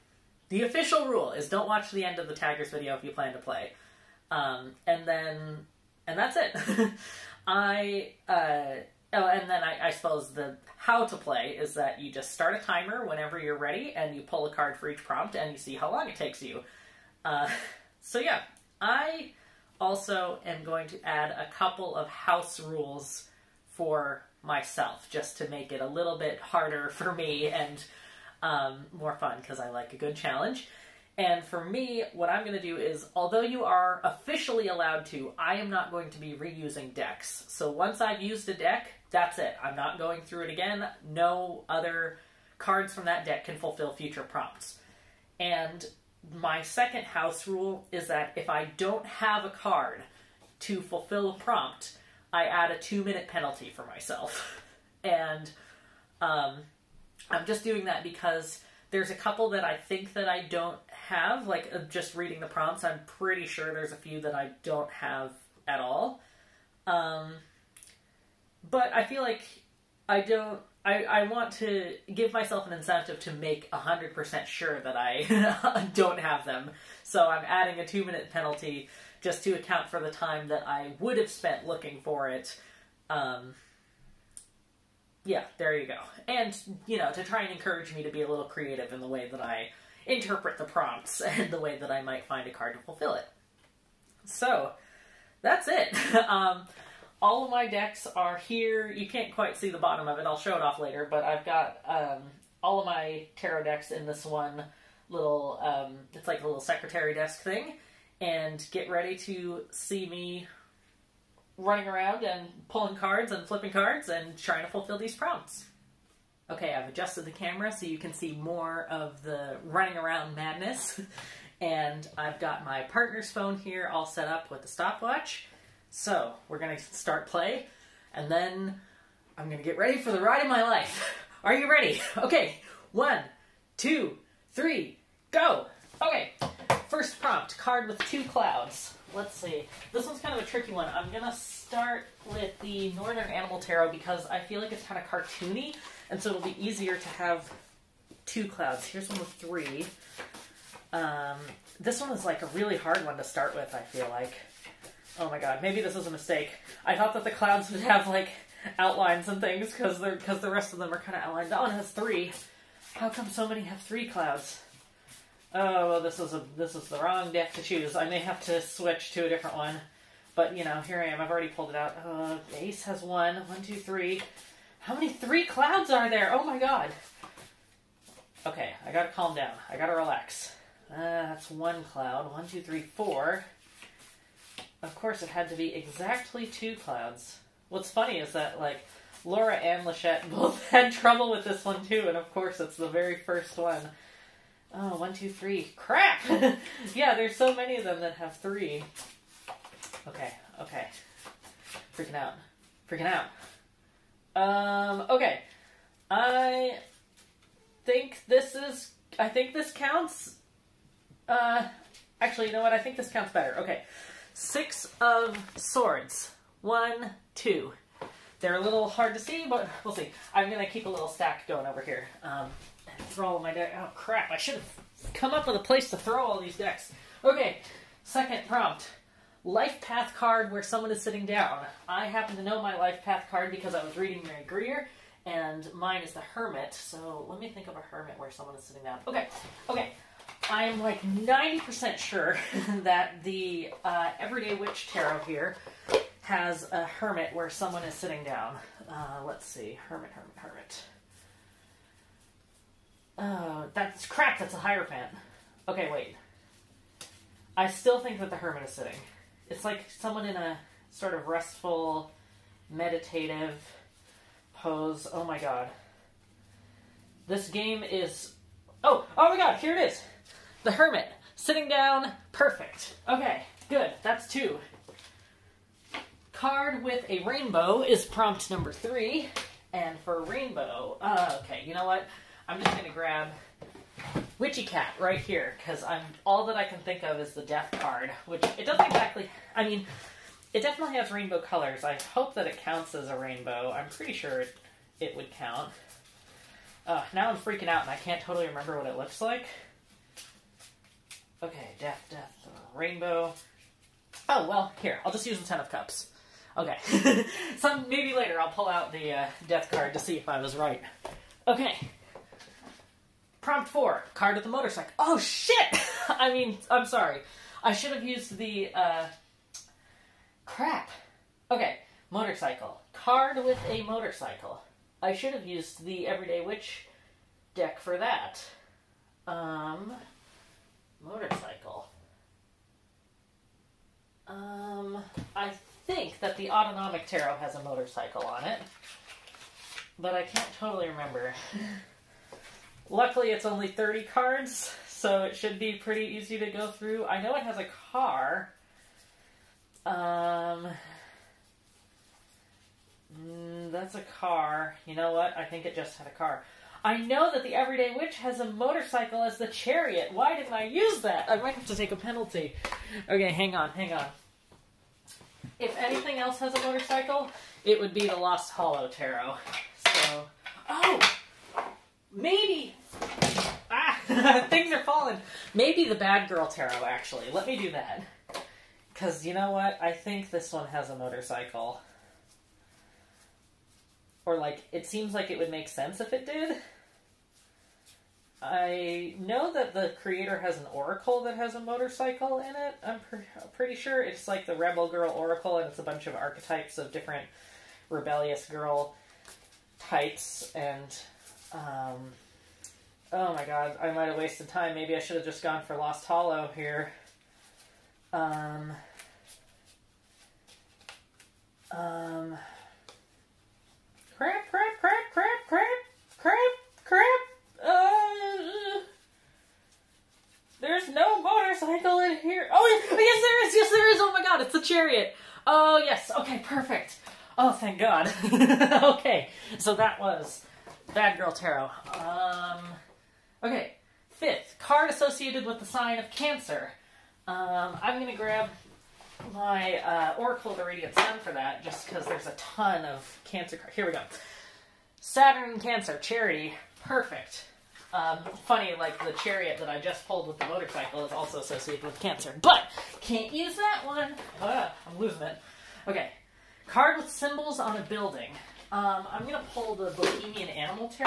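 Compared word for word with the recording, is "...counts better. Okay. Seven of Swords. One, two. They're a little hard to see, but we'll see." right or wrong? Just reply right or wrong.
wrong.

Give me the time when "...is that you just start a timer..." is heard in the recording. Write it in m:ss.
0:11.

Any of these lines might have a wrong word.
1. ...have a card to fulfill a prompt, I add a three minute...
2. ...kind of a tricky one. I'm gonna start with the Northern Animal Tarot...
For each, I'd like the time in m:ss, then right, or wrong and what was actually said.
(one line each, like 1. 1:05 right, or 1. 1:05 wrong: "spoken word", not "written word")
1. 0:49 wrong: "two", not "three"
2. 2:20 right.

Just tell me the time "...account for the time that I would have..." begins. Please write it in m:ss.
1:19.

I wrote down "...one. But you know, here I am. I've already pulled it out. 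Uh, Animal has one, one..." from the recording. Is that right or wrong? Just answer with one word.
wrong.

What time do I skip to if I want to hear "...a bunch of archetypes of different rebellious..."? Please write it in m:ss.
6:35.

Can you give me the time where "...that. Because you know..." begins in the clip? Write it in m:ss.
6:17.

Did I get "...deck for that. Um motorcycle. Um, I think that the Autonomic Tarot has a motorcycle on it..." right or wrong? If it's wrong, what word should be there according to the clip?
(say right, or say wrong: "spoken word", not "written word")
right.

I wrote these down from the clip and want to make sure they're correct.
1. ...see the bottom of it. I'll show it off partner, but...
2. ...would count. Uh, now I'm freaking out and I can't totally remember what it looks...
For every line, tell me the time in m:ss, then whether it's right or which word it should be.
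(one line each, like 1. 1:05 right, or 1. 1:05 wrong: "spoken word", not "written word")
1. 1:39 wrong: "later", not "partner"
2. 4:55 right.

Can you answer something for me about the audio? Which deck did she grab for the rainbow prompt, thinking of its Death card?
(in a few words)
Witchy Cat.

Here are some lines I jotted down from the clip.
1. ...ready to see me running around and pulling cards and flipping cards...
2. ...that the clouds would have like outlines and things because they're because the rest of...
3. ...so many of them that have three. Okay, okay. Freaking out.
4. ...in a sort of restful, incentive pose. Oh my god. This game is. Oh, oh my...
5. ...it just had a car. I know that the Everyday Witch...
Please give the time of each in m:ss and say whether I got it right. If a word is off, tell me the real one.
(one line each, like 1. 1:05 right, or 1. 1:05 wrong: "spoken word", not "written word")
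1. 1:48 right
2. 2:37 right
3. 3:17 right
4. 4:20 wrong: "meditative", not "incentive"
5. 5:55 right.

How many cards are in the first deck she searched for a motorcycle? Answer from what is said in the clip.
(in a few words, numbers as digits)
30.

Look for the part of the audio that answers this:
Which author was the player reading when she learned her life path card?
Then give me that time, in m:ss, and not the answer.
3:54.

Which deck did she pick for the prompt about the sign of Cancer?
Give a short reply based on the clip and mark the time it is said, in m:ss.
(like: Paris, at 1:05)
Oracle of the Radiant Sun, at 7:20.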